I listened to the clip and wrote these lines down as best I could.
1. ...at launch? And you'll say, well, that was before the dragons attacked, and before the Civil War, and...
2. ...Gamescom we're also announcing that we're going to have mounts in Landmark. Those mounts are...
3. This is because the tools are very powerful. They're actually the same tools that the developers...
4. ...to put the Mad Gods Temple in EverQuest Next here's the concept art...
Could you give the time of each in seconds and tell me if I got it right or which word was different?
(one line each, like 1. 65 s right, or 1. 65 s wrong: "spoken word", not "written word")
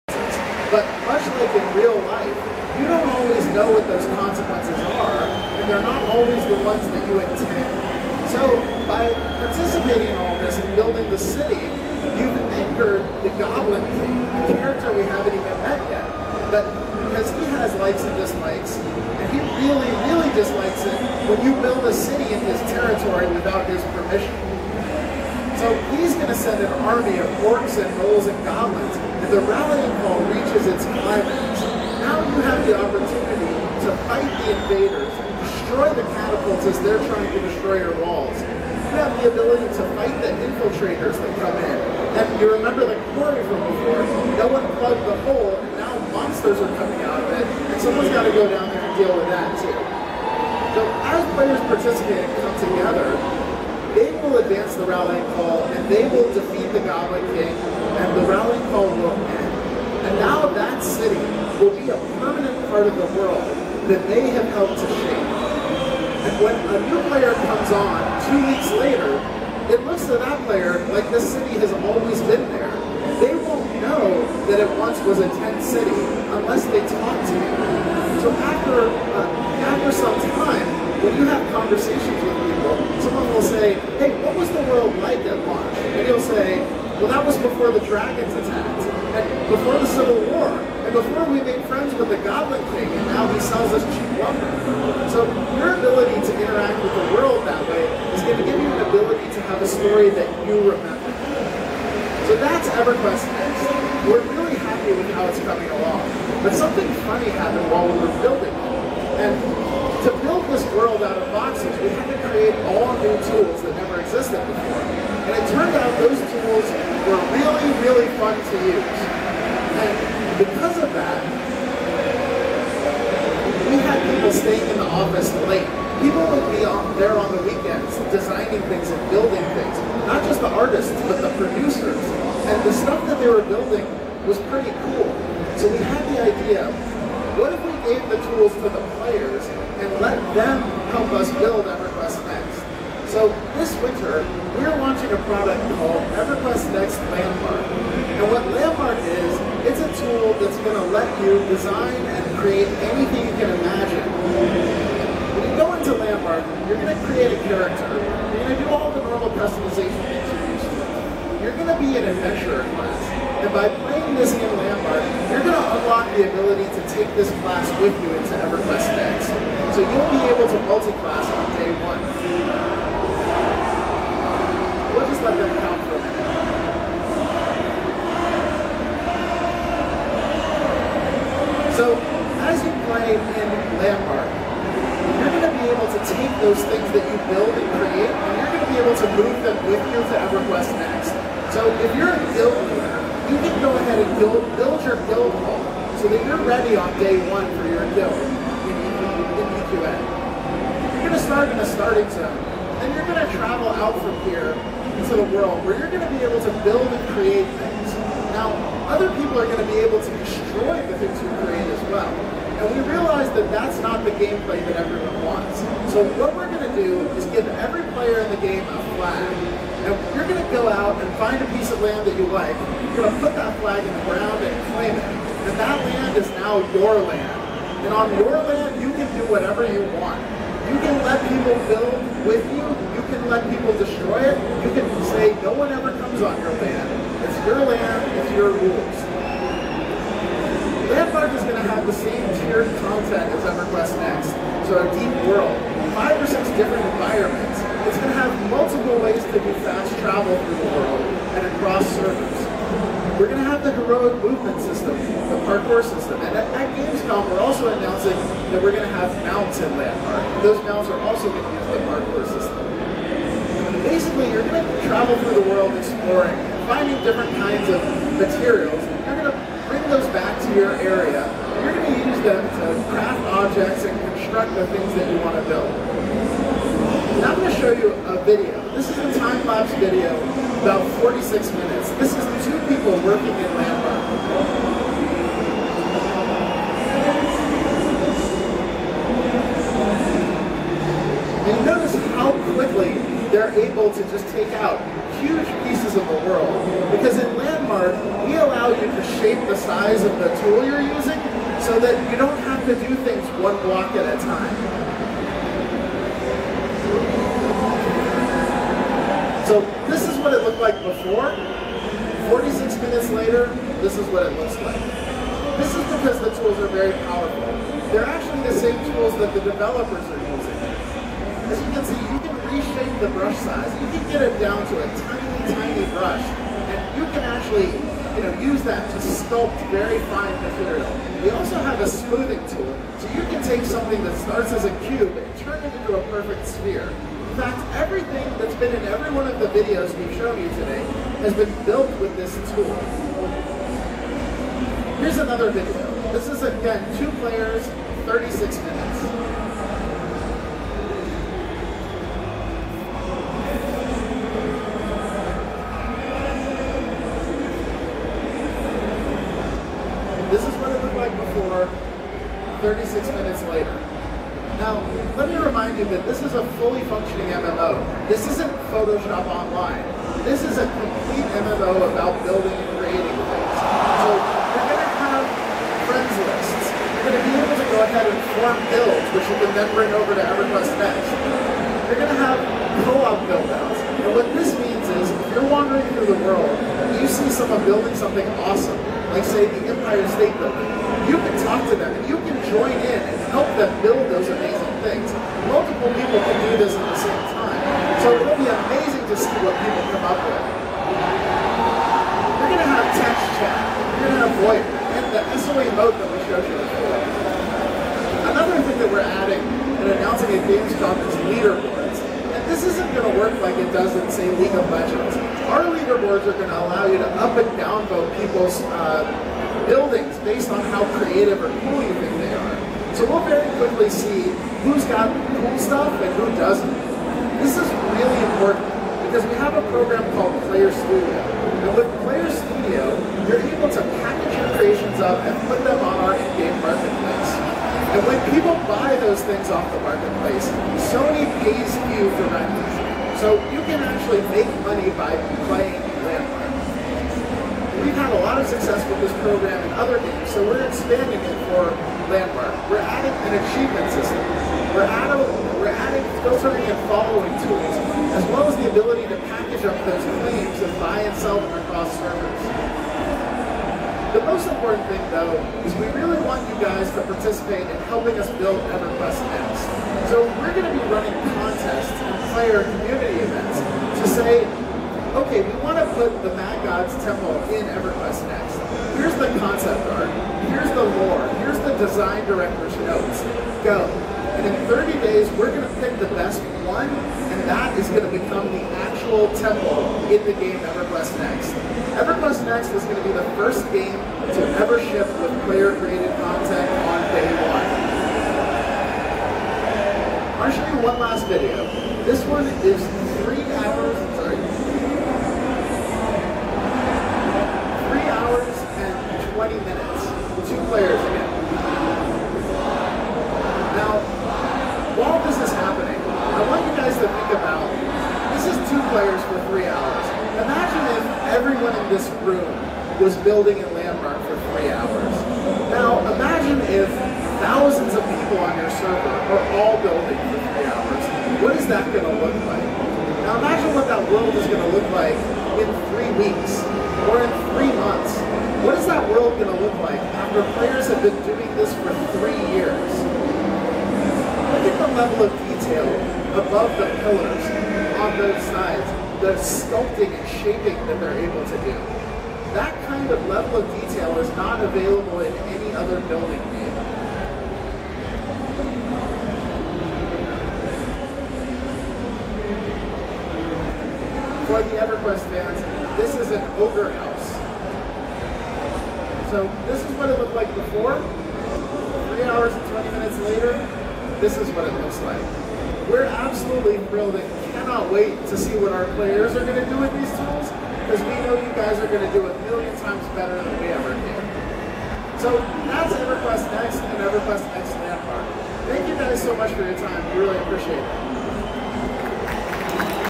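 1. 85 s right
2. 256 s right
3. 315 s right
4. 475 s right.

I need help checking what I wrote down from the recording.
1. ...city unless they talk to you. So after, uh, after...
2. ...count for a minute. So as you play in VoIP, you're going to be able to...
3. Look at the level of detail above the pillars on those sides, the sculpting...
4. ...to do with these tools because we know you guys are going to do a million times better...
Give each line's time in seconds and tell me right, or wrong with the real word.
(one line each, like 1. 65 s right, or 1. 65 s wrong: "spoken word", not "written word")
1. 75 s right
2. 175 s wrong: "Landmark", not "VoIP"
3. 544 s right
4. 579 s right.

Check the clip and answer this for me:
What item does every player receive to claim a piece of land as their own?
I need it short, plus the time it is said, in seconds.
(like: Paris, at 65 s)
a flag, at 218 s.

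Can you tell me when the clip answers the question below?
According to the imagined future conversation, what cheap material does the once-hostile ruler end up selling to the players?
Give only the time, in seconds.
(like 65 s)
94 s.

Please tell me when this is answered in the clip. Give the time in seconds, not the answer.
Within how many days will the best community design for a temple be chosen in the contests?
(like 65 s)
484 s.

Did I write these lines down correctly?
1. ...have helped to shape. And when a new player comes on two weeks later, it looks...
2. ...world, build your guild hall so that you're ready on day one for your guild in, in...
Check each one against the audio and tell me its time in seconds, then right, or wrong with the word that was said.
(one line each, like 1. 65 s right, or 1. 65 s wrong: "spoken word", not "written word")
1. 64 s right
2. 194 s wrong: "build", not "world".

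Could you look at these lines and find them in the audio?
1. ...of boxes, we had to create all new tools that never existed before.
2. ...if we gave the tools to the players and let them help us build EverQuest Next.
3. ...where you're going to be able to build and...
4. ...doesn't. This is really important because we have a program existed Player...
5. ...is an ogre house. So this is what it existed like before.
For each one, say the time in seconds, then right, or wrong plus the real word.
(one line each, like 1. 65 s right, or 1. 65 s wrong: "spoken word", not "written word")
1. 111 s right
2. 137 s right
3. 205 s right
4. 426 s wrong: "called", not "existed"
5. 566 s wrong: "looked", not "existed".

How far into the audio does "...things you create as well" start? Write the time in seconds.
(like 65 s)
210 s.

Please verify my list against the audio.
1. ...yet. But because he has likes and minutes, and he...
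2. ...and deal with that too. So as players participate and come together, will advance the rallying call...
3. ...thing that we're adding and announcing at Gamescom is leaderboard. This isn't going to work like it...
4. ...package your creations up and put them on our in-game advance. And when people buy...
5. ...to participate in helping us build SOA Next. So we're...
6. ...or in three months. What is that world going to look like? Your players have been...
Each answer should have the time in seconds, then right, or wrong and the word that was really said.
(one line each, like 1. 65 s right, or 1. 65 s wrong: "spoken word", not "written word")
1. 15 s wrong: "dislikes", not "minutes"
2. 48 s right
3. 408 s right
4. 434 s wrong: "marketplace", not "advance"
5. 466 s wrong: "EverQuest", not "SOA"
6. 537 s right.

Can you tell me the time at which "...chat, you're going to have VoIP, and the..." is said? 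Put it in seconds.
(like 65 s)
403 s.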